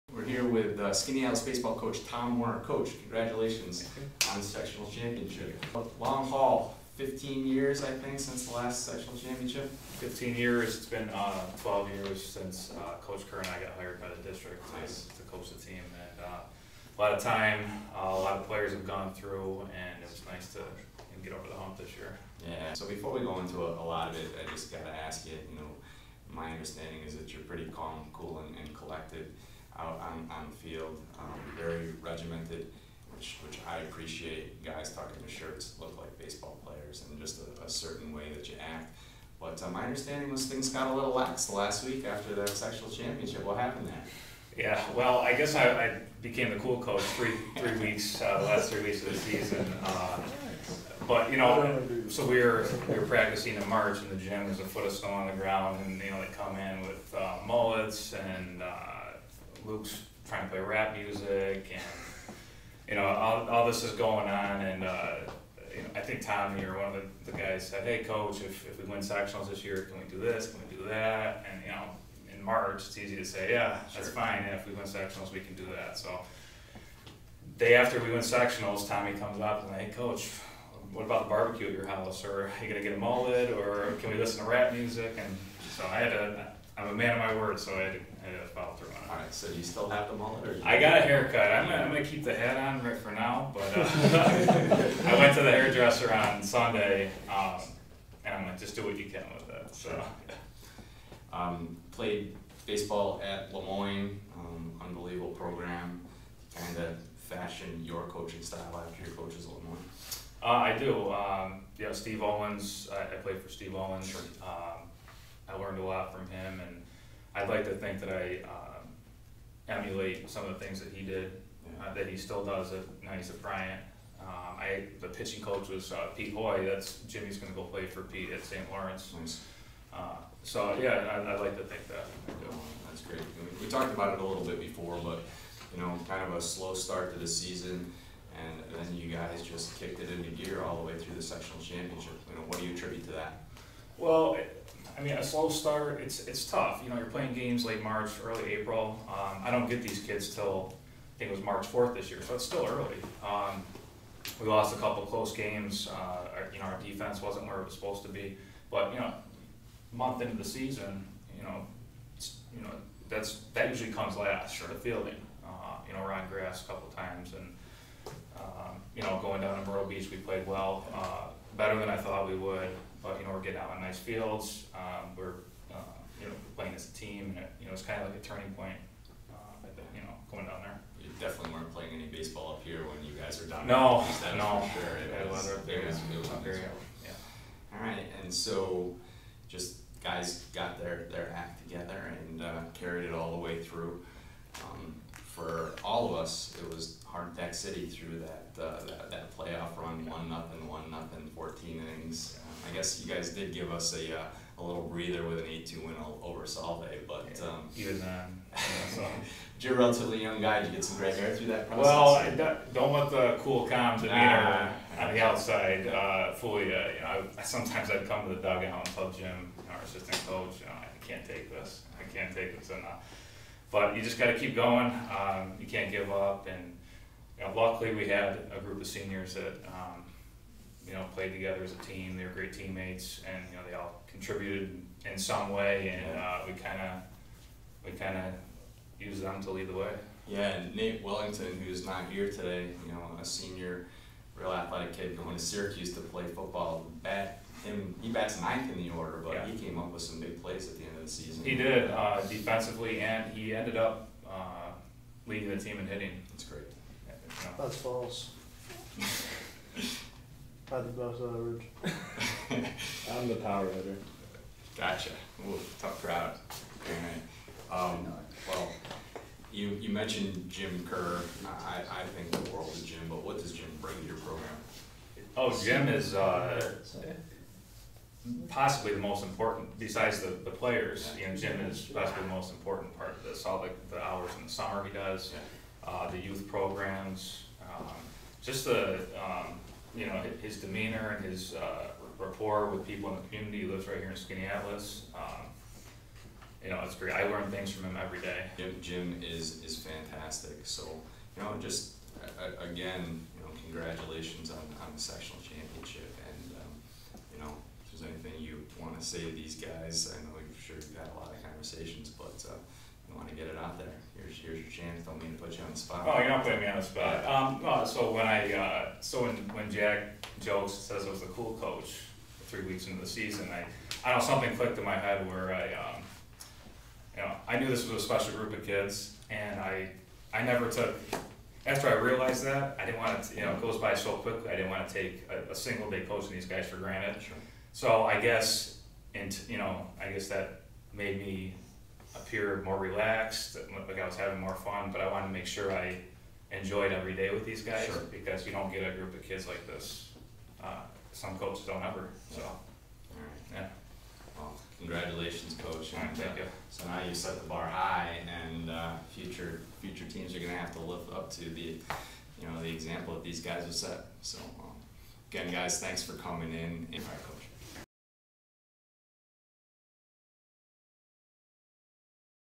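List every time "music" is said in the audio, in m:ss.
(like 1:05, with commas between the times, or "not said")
1:00, 1:24.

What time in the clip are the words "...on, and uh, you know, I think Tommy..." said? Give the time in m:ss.
1:04.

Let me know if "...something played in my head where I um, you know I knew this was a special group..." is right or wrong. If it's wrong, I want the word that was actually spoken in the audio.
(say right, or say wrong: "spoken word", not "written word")
wrong: "clicked", not "played".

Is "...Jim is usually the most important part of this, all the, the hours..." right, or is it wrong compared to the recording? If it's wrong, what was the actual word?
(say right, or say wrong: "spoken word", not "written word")
wrong: "possibly", not "usually".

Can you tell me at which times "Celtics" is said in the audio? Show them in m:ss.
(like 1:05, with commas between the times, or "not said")
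not said.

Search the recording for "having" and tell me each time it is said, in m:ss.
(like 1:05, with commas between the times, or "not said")
5:44.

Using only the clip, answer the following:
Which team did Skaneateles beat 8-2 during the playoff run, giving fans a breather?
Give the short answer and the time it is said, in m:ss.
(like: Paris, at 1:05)
Solvay, at 3:26.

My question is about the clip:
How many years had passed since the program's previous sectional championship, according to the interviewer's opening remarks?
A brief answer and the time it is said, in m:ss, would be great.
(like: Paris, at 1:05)
15, at 0:06.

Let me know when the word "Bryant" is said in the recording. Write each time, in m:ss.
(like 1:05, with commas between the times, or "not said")
2:03.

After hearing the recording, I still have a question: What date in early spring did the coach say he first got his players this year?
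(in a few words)
March 4th.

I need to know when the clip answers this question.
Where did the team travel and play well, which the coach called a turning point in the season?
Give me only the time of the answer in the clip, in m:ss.
2:49.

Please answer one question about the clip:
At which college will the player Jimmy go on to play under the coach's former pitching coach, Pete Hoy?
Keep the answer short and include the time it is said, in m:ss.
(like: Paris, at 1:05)
St. Lawrence, at 2:08.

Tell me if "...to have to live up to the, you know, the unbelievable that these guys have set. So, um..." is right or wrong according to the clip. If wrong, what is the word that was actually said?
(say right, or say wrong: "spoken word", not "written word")
wrong: "example", not "unbelievable".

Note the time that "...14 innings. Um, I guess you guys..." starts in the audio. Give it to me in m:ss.
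3:21.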